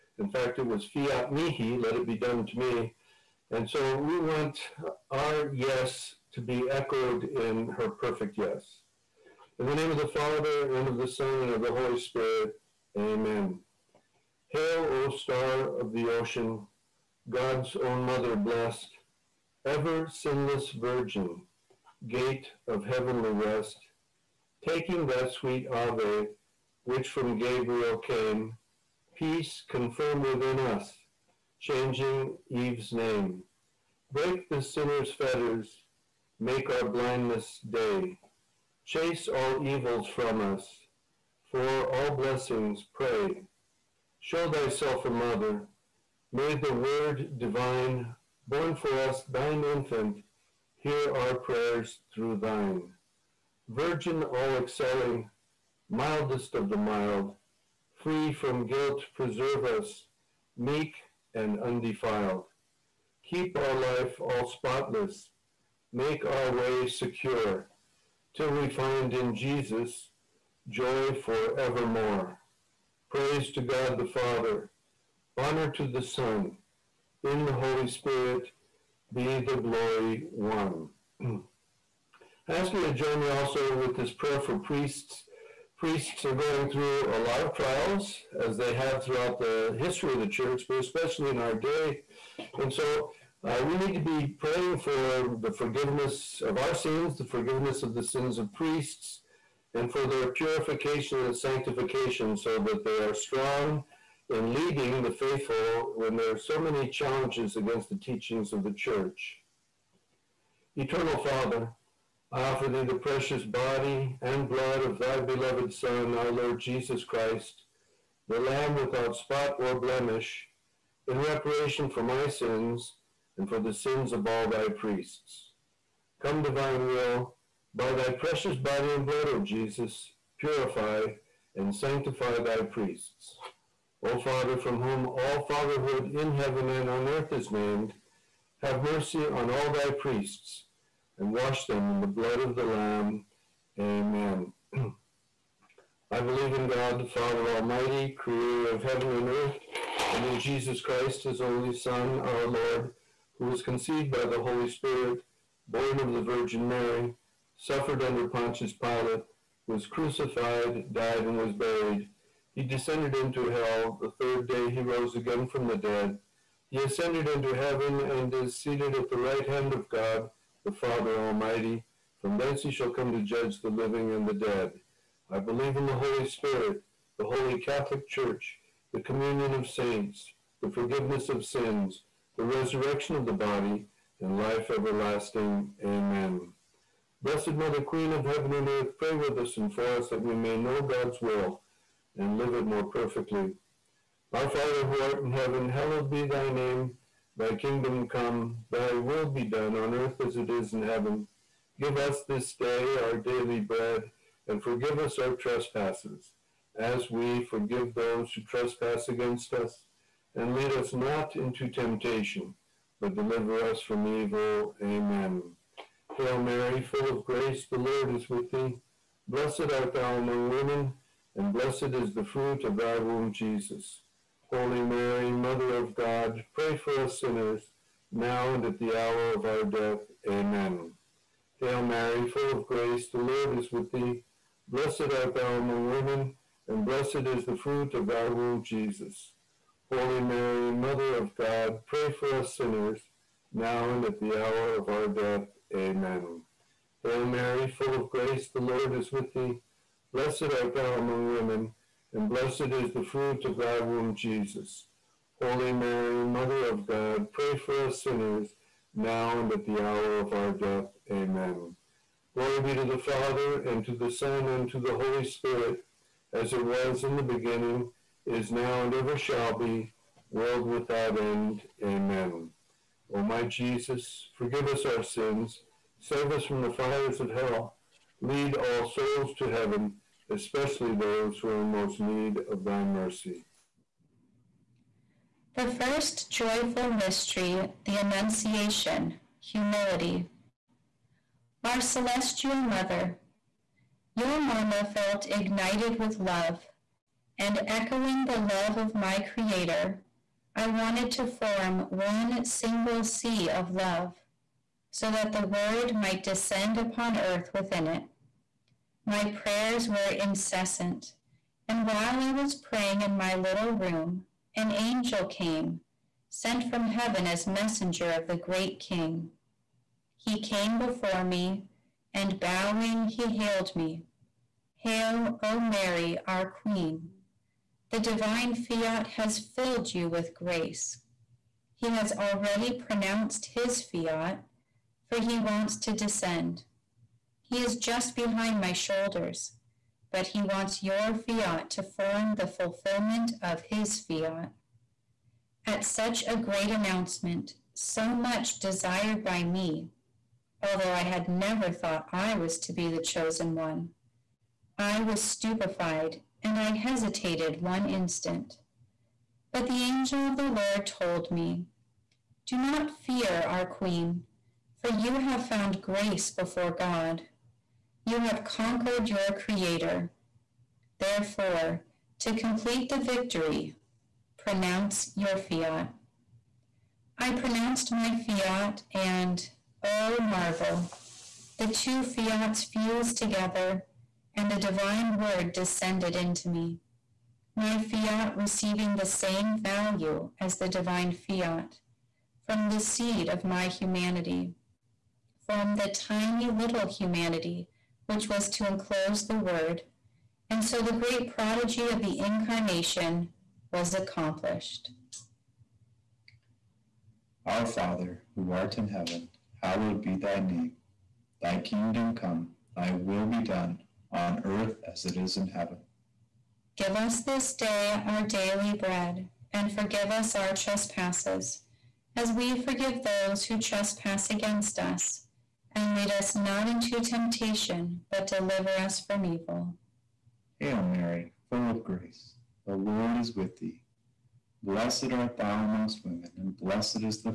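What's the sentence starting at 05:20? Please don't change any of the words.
He came before me, and bowing, he hailed me.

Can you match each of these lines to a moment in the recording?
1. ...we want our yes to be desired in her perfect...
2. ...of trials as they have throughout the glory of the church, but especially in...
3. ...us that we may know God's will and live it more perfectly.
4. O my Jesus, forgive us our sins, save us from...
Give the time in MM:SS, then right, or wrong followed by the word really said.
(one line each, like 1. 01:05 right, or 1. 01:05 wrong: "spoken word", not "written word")
1. 00:03 wrong: "echoed", not "desired"
2. 01:27 wrong: "history", not "glory"
3. 03:09 right
4. 04:33 right.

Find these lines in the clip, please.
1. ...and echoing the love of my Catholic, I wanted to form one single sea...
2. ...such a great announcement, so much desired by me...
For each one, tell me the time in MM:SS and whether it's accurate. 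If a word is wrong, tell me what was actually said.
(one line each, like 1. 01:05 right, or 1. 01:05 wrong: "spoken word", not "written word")
1. 04:57 wrong: "Creator", not "Catholic"
2. 05:45 right.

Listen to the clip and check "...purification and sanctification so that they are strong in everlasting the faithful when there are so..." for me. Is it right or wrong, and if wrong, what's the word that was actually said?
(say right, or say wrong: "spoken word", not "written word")
wrong: "leading", not "everlasting".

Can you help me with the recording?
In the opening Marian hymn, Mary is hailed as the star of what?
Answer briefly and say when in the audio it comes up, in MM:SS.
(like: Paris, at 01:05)
the ocean, at 00:15.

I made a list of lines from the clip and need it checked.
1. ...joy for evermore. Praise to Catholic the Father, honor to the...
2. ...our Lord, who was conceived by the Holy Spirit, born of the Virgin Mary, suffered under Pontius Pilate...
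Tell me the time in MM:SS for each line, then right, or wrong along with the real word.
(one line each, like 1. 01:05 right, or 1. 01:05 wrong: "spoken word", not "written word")
1. 01:10 wrong: "God", not "Catholic"
2. 02:32 right.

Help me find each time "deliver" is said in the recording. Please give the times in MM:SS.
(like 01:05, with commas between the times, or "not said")
03:33, 07:08.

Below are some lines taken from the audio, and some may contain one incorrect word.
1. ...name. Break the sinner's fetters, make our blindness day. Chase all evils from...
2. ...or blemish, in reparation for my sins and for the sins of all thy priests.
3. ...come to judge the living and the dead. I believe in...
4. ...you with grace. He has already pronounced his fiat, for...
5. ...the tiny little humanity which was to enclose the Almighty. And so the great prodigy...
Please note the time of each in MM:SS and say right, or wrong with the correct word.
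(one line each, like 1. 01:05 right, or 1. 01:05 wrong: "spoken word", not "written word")
1. 00:32 right
2. 01:59 right
3. 02:52 right
4. 05:29 right
5. 06:35 wrong: "Word", not "Almighty".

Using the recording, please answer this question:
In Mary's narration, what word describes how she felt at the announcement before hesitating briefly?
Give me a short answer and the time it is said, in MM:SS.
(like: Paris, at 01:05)
stupefied, at 05:55.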